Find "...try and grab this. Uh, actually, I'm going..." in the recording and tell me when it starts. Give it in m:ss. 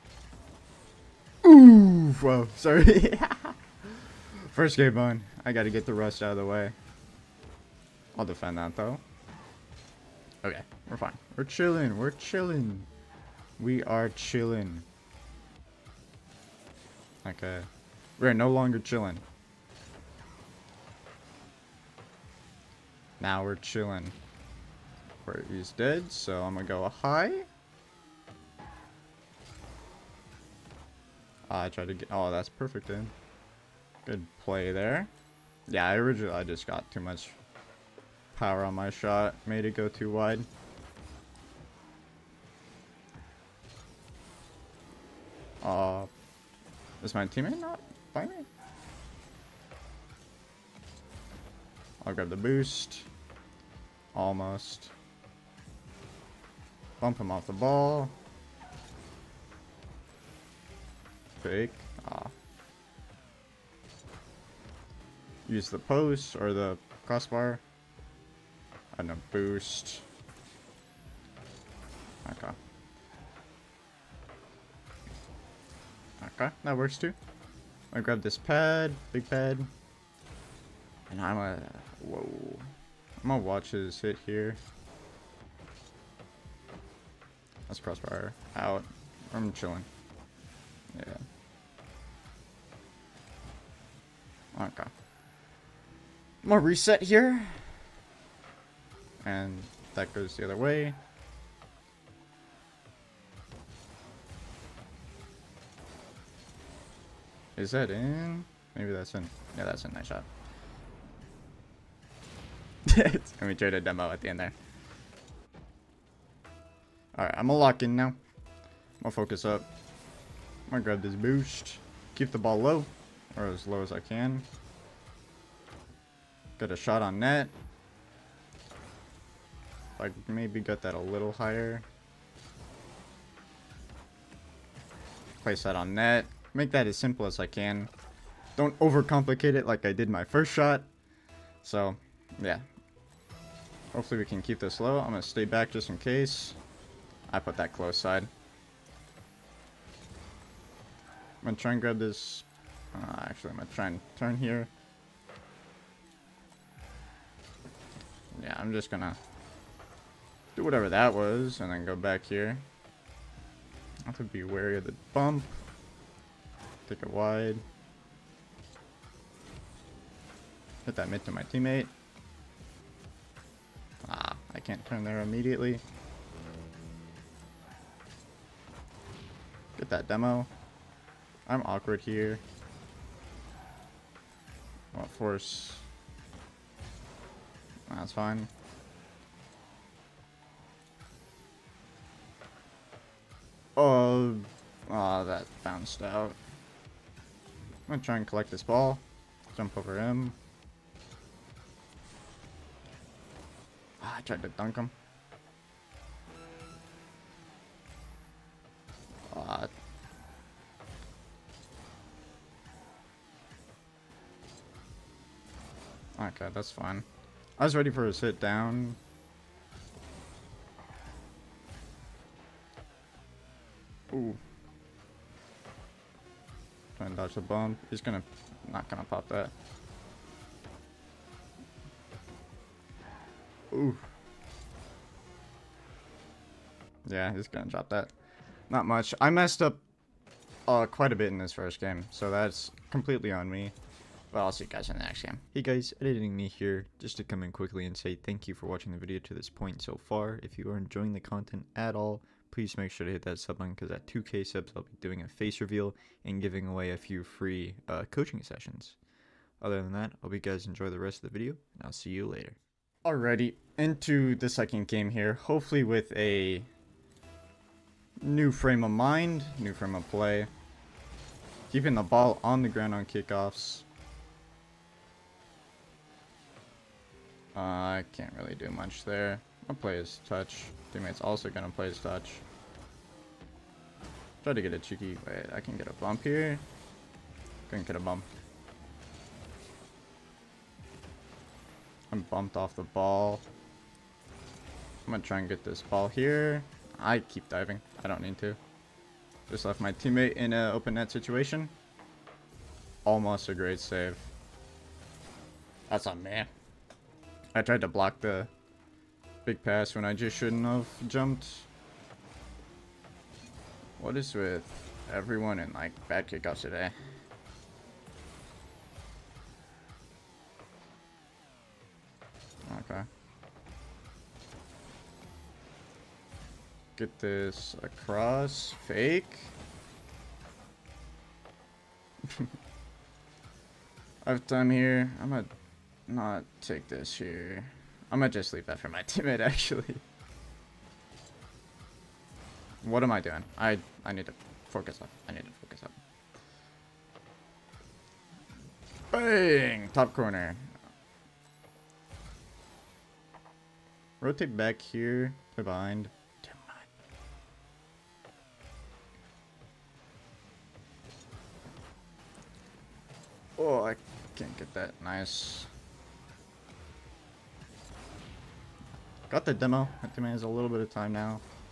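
2:31.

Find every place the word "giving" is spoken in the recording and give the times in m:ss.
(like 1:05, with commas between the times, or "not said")
4:16.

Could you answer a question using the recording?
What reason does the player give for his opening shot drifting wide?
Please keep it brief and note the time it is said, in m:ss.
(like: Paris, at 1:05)
too much power, at 0:36.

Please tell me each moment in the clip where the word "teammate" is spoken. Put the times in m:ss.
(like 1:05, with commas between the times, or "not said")
0:47, 2:51, 4:40, 4:59, 5:39.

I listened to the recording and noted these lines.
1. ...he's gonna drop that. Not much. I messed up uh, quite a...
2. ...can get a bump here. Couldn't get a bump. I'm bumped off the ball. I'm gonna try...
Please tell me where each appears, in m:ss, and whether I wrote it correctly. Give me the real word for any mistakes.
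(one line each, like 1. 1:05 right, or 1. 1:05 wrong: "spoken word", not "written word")
1. 3:57 right
2. 4:45 right.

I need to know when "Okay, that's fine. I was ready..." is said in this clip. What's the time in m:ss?
3:36.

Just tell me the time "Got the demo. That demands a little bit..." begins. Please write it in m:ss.
6:09.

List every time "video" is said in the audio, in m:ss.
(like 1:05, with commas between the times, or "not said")
4:08, 4:21.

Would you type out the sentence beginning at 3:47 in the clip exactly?
He's gonna not gonna pop that.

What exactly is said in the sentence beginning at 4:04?
Well, I'll see you guys in the next game.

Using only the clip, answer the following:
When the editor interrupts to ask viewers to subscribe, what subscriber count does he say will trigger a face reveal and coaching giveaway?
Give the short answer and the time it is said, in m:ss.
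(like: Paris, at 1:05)
2k, at 4:14.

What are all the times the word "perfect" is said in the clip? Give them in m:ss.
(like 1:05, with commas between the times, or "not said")
0:32.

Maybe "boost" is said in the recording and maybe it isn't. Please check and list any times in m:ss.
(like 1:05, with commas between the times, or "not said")
0:52, 1:09, 2:01.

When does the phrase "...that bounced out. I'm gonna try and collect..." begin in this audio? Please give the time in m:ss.
3:15.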